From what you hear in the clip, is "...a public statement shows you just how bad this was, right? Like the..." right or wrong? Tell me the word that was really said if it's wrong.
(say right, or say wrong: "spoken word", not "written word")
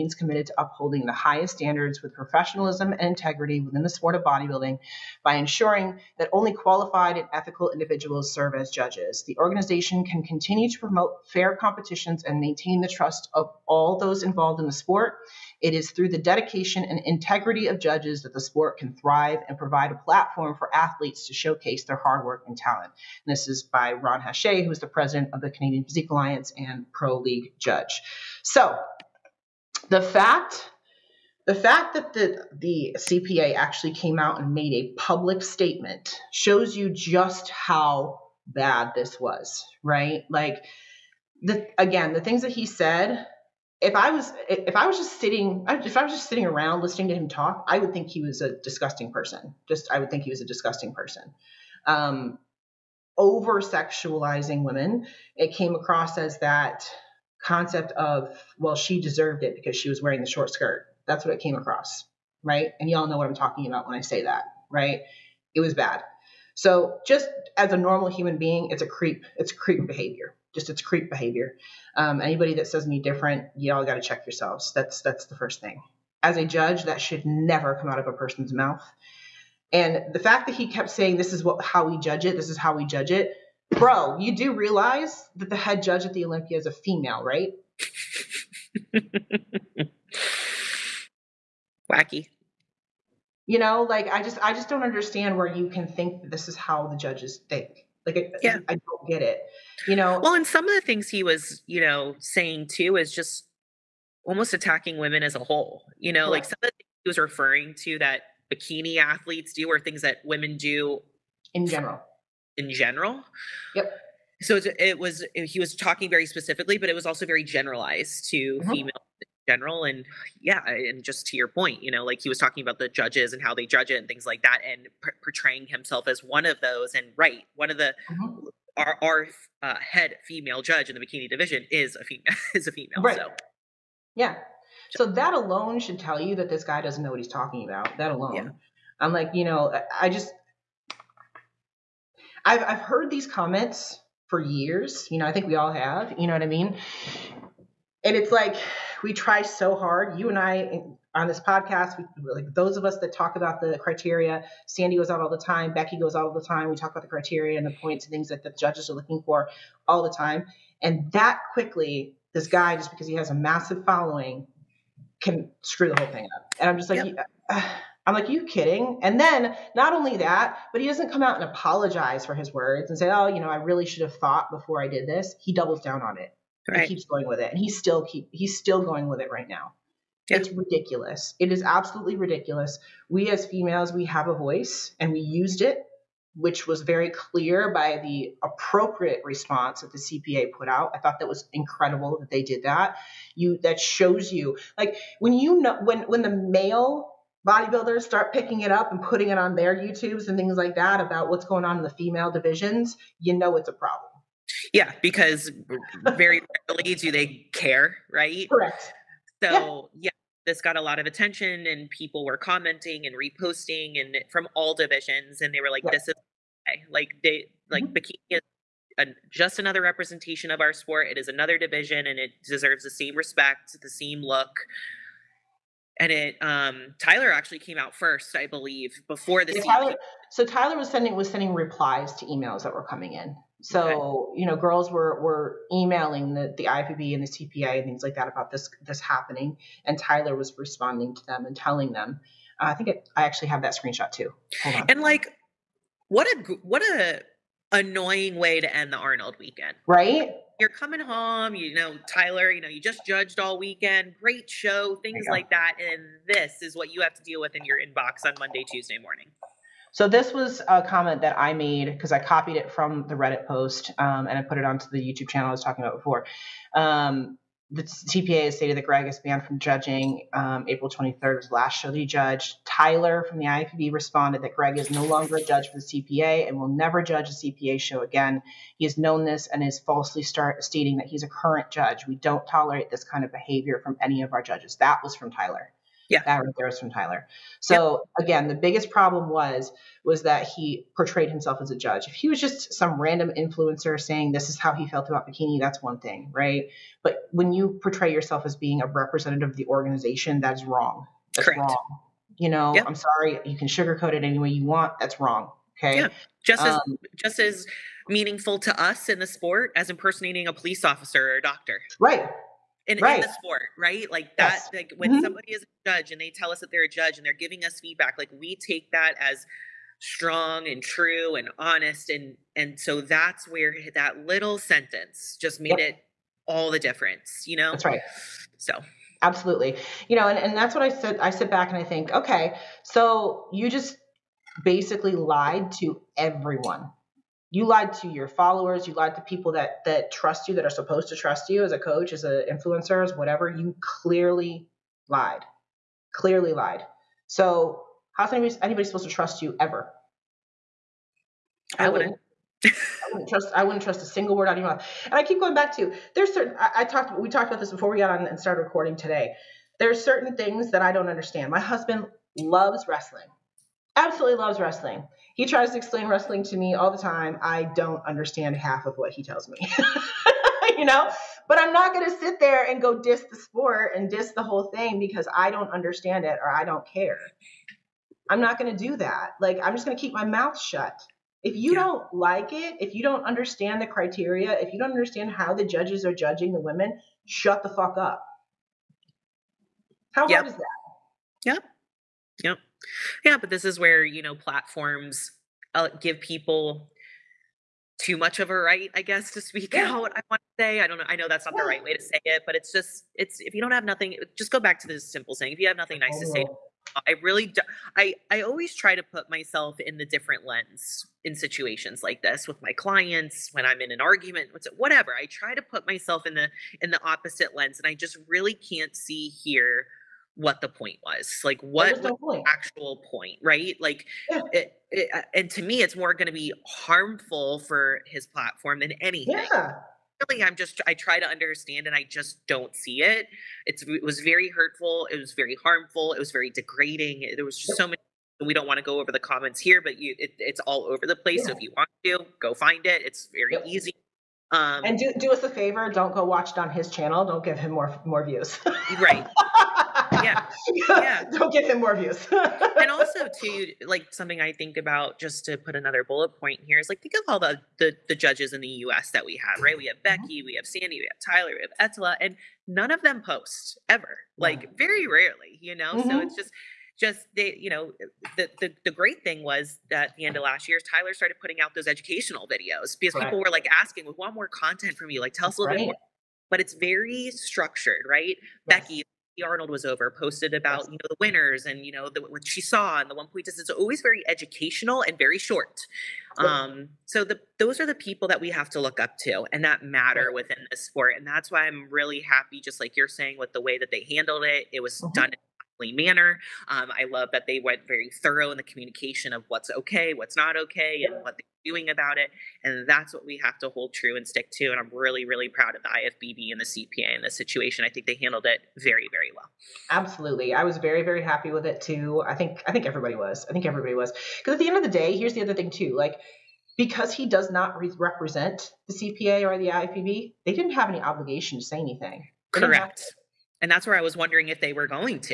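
right.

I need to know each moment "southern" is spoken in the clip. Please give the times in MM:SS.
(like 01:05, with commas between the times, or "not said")
not said.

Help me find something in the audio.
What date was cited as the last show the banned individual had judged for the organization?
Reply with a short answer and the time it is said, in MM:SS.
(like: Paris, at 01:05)
April 23rd, at 04:30.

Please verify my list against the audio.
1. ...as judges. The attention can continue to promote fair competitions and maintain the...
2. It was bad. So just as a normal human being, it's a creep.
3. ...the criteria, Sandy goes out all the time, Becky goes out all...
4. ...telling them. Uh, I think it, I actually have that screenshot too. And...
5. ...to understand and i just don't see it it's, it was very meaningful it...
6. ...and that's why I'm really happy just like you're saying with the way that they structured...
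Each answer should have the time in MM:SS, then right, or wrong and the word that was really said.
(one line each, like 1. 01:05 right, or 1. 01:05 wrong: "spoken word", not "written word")
1. 00:08 wrong: "organization", not "attention"
2. 01:05 right
3. 02:33 right
4. 04:01 right
5. 07:11 wrong: "hurtful", not "meaningful"
6. 08:11 wrong: "handled", not "structured".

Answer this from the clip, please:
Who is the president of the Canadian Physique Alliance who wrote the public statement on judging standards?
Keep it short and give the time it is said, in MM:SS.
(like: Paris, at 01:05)
Ron Hache, at 00:23.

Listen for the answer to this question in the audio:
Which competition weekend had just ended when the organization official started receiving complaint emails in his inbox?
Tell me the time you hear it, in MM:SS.
04:08.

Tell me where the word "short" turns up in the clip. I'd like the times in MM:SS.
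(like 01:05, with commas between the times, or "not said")
01:00, 08:05.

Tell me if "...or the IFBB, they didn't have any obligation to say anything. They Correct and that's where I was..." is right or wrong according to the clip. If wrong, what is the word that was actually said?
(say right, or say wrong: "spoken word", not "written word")
right.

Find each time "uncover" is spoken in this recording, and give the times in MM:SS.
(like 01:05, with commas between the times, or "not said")
not said.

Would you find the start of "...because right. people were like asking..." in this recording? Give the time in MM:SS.
07:52.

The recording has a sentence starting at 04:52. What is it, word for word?
If he was just some random influencer saying this is how he felt about bikini, that's one thing, right?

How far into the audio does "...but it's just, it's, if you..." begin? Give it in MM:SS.
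06:42.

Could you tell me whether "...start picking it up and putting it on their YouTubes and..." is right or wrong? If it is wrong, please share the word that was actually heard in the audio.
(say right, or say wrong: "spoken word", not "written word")
right.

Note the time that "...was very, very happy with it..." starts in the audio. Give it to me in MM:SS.
08:30.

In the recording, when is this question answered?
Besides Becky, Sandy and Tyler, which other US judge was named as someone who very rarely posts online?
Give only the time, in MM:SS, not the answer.
07:41.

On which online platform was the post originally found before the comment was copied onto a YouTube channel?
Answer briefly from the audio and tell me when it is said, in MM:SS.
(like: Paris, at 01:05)
Reddit, at 04:23.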